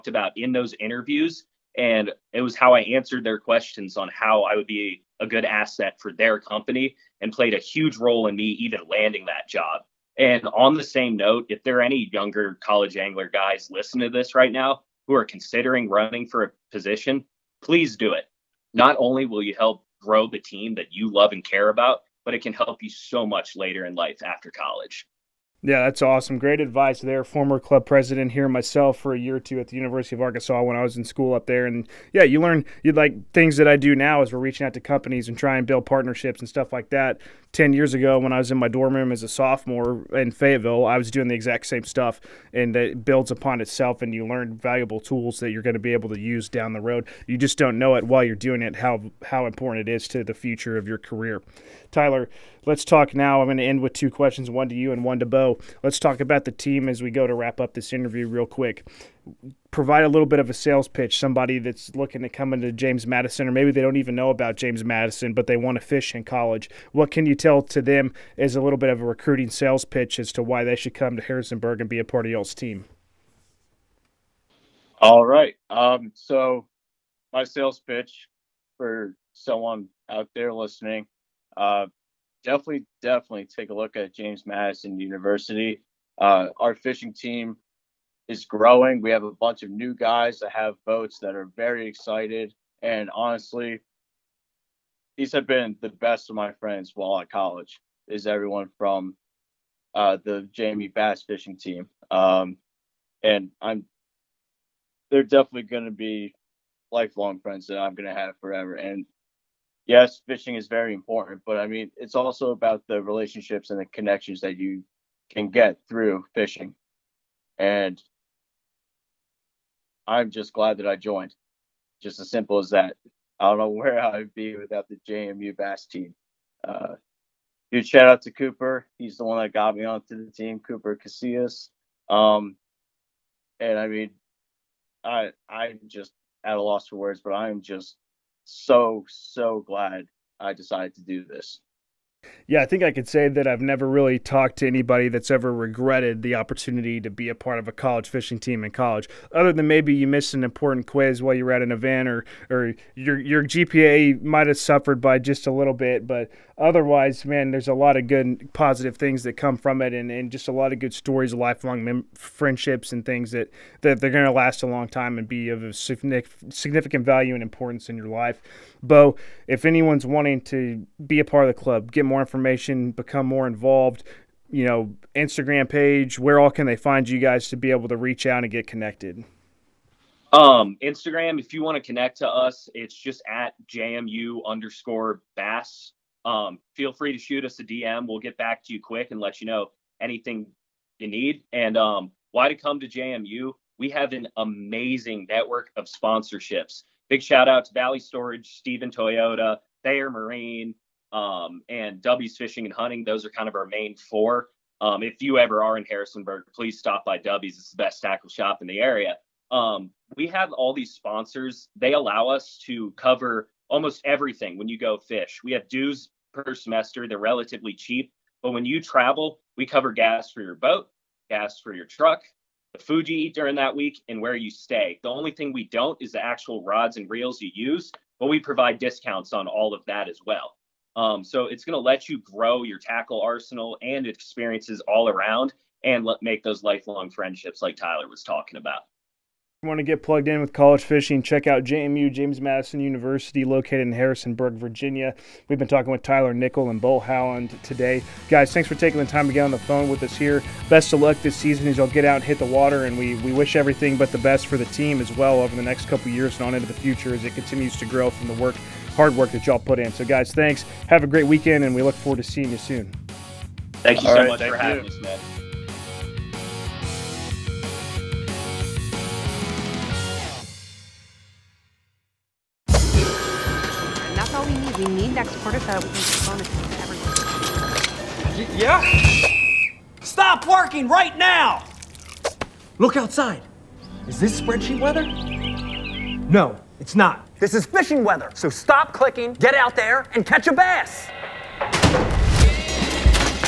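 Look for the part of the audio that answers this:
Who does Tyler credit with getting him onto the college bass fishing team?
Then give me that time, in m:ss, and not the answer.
2:10.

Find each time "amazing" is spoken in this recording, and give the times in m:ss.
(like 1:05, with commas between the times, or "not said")
3:14.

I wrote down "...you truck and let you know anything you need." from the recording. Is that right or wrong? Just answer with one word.
wrong.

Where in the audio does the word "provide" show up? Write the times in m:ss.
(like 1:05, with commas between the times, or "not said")
0:59, 3:48.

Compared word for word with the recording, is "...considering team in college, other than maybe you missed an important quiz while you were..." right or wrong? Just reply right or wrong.
wrong.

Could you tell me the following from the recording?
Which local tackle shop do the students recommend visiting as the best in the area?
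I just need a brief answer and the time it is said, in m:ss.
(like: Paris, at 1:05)
W's Fishing and Hunting, at 3:22.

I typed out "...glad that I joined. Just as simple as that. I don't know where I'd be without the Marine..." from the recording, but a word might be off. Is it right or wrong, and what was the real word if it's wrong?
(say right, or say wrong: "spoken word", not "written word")
wrong: "JMU", not "Marine".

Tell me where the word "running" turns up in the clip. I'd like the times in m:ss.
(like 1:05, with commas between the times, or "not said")
0:15.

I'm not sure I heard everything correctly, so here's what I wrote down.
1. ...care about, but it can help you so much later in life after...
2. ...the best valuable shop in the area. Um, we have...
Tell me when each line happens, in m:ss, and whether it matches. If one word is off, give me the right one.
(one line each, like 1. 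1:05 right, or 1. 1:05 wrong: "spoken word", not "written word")
1. 0:21 right
2. 3:27 wrong: "tackle", not "valuable".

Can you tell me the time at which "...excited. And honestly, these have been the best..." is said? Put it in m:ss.
1:31.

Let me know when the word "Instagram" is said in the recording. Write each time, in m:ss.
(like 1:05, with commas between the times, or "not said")
2:55, 3:00.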